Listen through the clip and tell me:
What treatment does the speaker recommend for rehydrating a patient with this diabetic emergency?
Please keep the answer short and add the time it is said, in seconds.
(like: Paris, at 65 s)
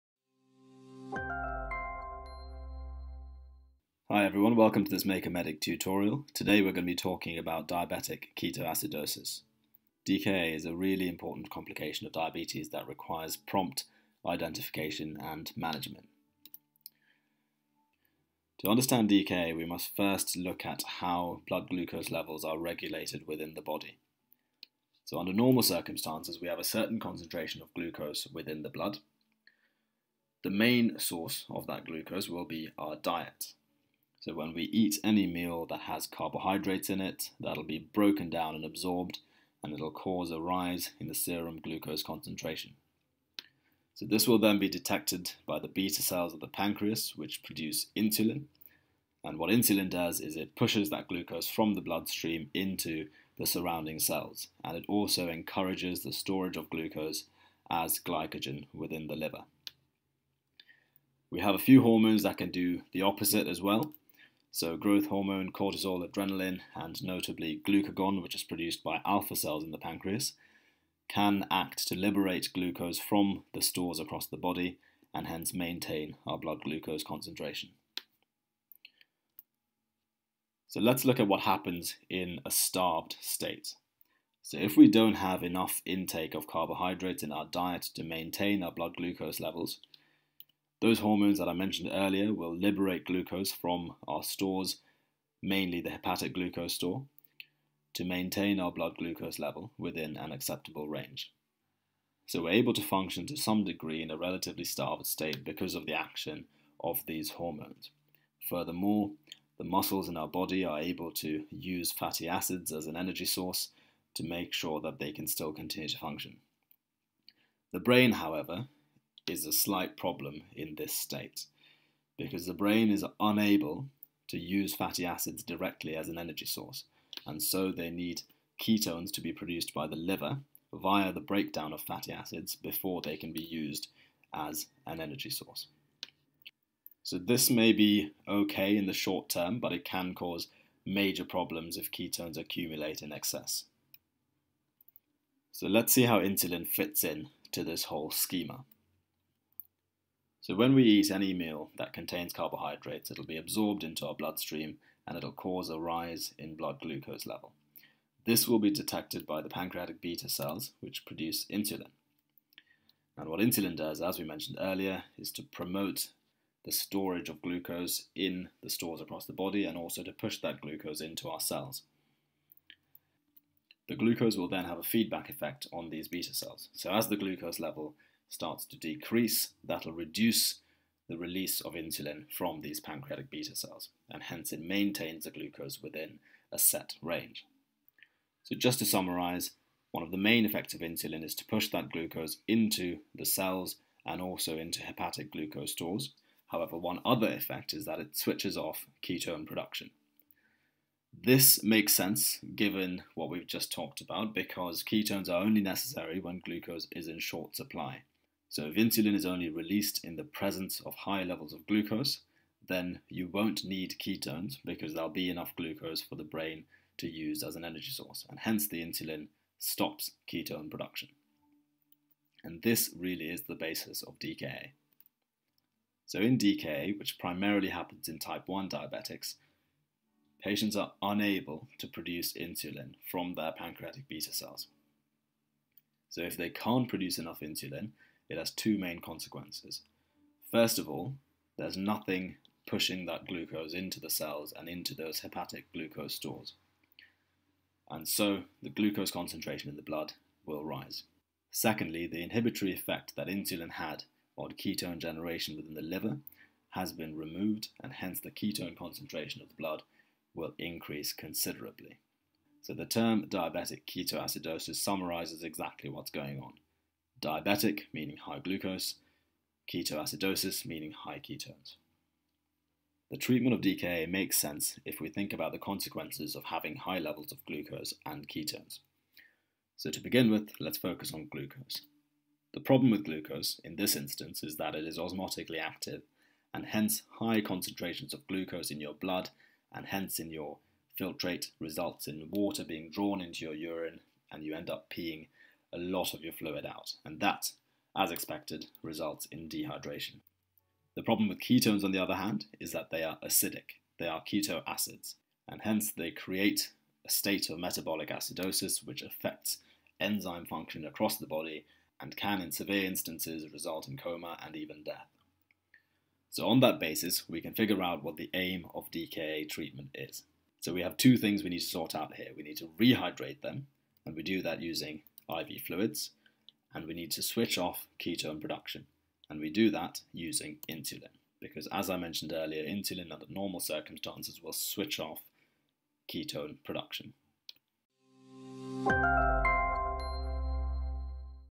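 IV fluids, at 325 s.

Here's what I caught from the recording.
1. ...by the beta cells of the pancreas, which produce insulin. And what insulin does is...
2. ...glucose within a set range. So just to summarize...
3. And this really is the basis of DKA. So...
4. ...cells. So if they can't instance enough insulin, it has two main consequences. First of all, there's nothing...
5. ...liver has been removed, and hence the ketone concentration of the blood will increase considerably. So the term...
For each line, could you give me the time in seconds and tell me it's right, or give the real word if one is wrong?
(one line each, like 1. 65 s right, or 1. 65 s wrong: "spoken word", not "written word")
1. 45 s right
2. 185 s right
3. 222 s right
4. 234 s wrong: "produce", not "instance"
5. 255 s right.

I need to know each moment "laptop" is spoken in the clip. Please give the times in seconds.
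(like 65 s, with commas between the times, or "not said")
not said.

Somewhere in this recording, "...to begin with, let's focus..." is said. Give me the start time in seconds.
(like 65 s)
279 s.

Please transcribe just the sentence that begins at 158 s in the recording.
This will be detected by the pancreatic beta cells, which produce insulin.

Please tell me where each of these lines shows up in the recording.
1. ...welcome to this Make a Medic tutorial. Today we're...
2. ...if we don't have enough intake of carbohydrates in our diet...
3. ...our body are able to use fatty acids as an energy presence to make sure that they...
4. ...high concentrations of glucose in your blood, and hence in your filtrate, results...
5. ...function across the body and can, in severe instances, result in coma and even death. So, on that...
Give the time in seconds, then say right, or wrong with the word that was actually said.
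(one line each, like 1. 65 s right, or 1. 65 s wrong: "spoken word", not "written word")
1. 4 s right
2. 84 s right
3. 110 s wrong: "source", not "presence"
4. 287 s right
5. 310 s right.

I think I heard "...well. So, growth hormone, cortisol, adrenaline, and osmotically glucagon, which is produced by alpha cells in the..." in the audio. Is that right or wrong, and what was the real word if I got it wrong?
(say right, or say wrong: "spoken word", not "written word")
wrong: "notably", not "osmotically".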